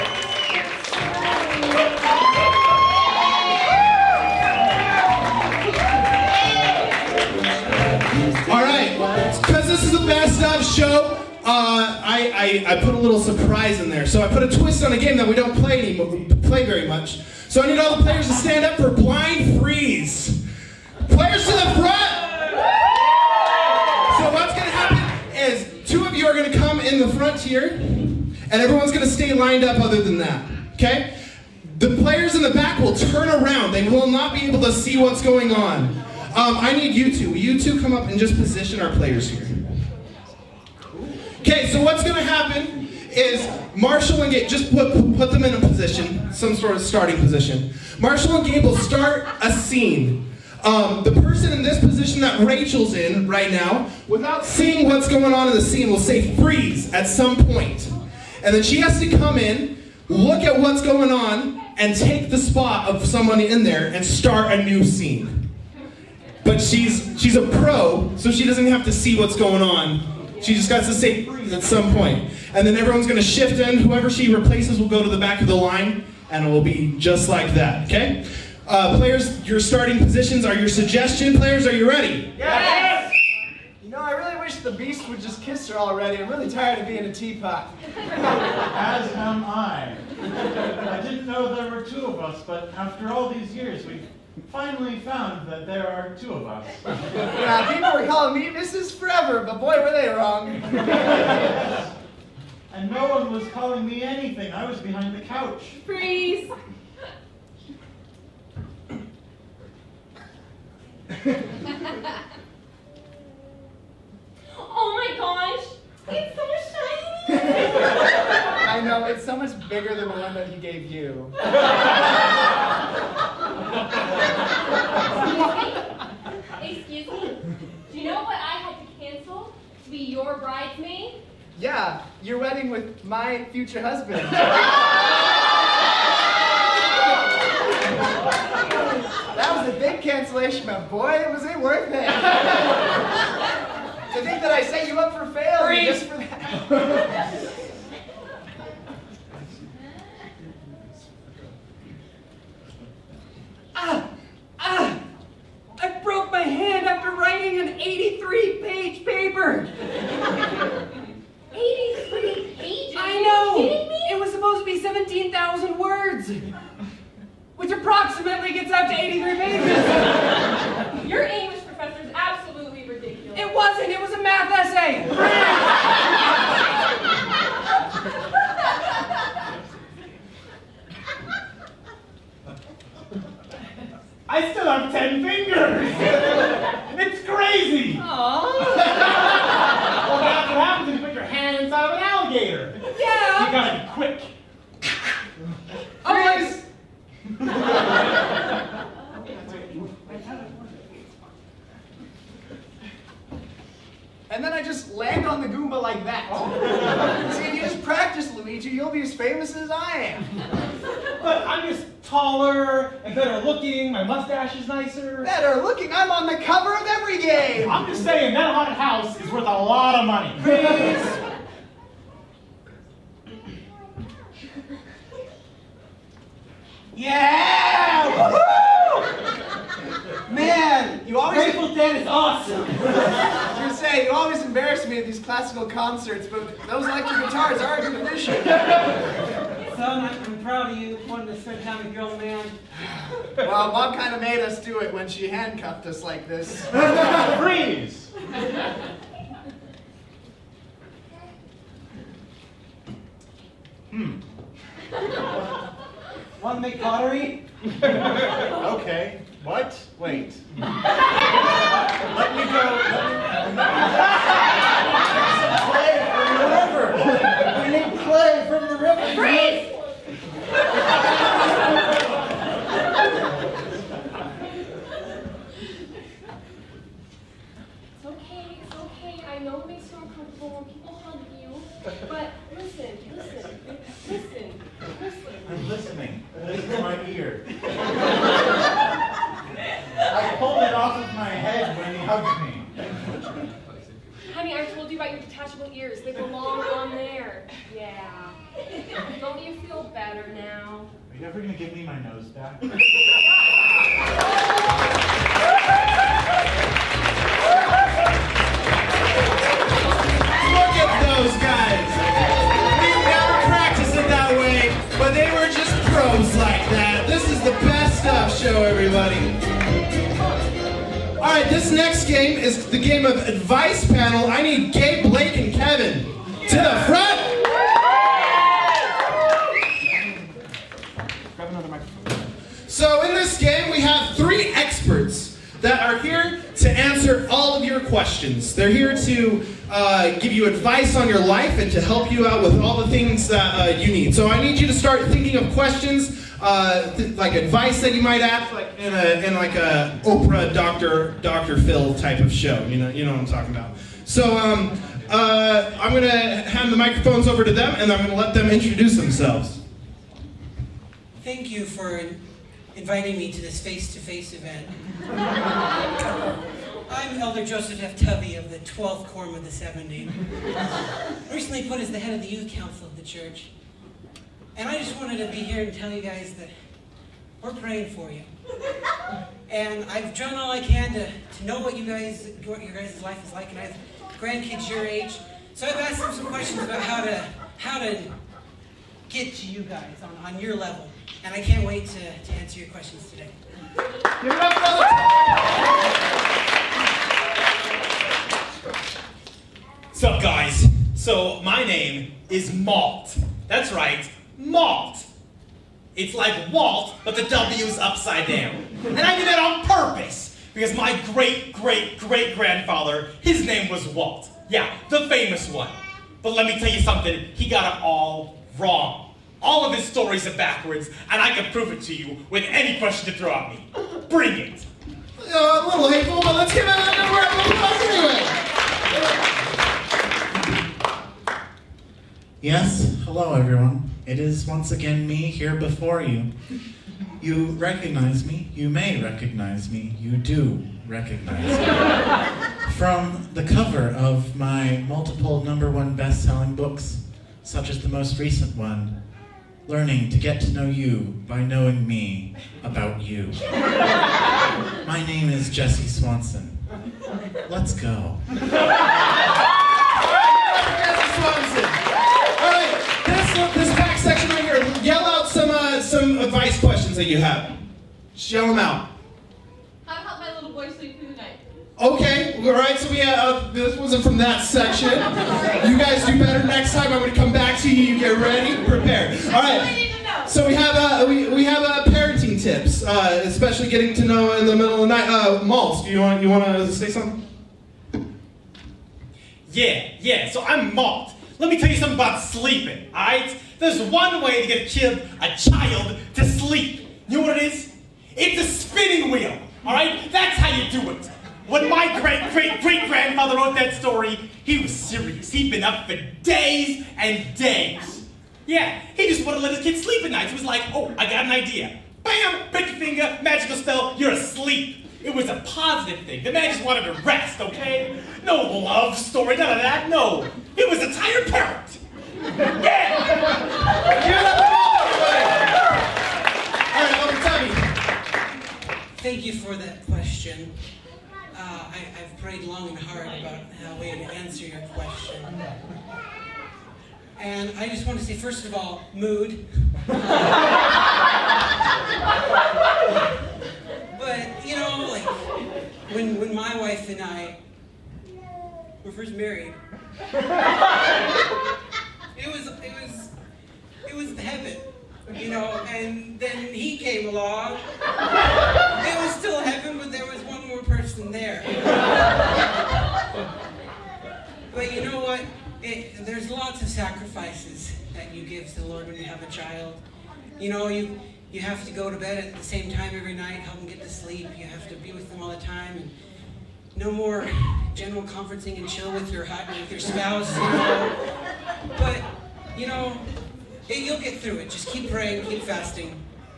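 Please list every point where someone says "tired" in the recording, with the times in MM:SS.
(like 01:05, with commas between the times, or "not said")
01:26, 08:40.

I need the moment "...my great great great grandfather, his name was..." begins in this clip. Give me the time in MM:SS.
06:50.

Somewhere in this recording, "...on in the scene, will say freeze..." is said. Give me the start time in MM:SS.
00:55.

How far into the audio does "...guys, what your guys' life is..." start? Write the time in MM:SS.
06:21.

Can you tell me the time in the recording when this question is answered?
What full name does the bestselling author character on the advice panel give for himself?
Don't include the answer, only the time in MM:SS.
07:35.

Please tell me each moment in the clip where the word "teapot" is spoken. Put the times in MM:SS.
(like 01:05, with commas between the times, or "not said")
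01:27.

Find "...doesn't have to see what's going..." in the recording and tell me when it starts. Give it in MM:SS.
01:08.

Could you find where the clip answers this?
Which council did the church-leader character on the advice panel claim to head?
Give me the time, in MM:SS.
06:12.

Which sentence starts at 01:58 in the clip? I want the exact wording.
I know, it's so much bigger than the one that he gave you.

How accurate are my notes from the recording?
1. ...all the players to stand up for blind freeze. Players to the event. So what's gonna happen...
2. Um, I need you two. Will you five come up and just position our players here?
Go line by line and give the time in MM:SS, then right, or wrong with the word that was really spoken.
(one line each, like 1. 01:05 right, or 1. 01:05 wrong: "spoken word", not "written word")
1. 00:17 wrong: "front", not "event"
2. 00:36 wrong: "two", not "five".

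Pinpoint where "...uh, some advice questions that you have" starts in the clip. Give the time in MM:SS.
07:45.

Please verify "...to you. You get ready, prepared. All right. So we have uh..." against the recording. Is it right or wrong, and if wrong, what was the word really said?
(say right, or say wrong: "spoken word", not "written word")
right.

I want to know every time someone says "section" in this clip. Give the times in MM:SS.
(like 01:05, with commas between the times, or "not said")
07:43, 07:54.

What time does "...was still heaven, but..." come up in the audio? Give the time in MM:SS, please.
09:19.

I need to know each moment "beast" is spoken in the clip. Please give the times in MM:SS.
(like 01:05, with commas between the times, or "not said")
01:24.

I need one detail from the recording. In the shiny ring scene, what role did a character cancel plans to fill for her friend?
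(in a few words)
Bridesmaid.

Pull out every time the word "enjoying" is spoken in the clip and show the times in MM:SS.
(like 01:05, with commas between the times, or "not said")
not said.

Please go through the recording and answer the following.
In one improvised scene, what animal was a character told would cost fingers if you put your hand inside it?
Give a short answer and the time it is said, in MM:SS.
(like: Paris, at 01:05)
An alligator, at 03:12.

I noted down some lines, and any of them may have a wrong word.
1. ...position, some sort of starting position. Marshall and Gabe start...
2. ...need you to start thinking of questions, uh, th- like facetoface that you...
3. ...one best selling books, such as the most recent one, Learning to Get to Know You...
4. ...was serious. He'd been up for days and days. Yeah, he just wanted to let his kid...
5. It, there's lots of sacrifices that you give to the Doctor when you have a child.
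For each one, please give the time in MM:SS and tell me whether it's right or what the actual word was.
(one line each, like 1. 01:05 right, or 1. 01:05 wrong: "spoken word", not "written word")
1. 00:45 right
2. 05:44 wrong: "advice", not "facetoface"
3. 07:25 right
4. 08:24 right
5. 09:25 wrong: "Lord", not "Doctor".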